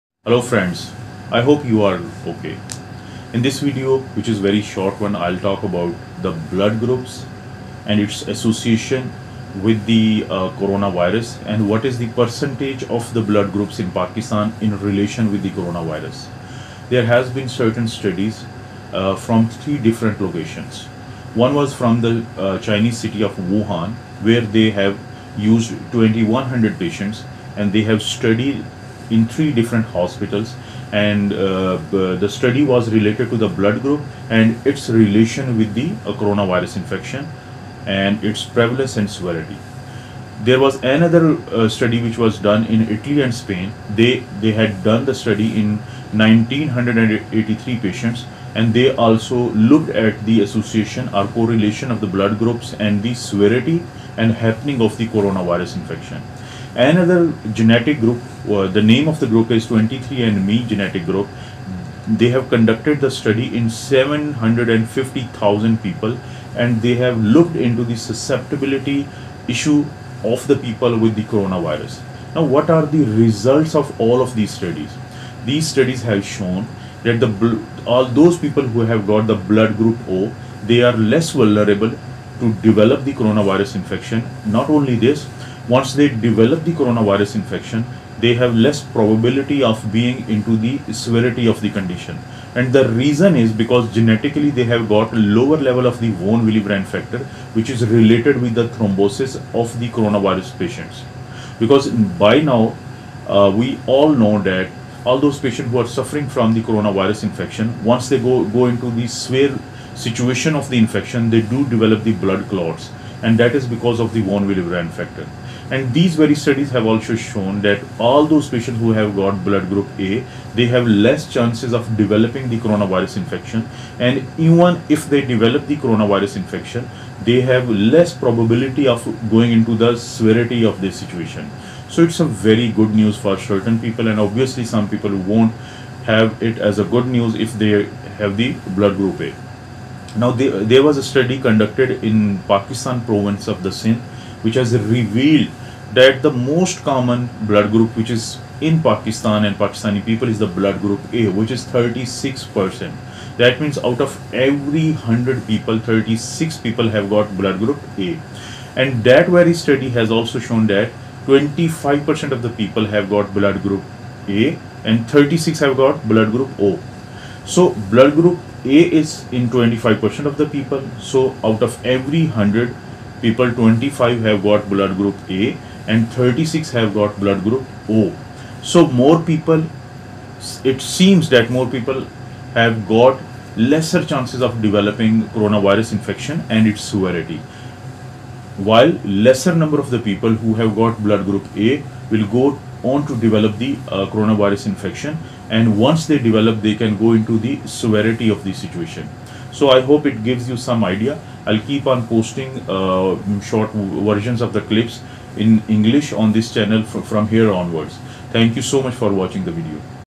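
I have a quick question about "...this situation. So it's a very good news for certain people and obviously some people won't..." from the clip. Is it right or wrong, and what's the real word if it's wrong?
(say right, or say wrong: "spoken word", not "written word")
right.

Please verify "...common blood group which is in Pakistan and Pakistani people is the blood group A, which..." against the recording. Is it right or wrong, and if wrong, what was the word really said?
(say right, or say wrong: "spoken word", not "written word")
right.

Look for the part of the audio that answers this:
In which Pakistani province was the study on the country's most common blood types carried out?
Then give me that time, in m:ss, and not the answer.
2:23.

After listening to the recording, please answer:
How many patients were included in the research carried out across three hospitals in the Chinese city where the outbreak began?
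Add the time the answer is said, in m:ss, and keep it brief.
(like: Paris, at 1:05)
2100, at 0:25.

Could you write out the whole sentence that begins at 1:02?
They have conducted the study in 750,000 people and they have looked into the susceptibility issue of the people with the coronavirus.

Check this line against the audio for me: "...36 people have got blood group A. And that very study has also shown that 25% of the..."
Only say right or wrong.
right.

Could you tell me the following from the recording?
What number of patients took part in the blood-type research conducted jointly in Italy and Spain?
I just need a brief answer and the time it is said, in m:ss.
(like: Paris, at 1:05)
1983, at 0:46.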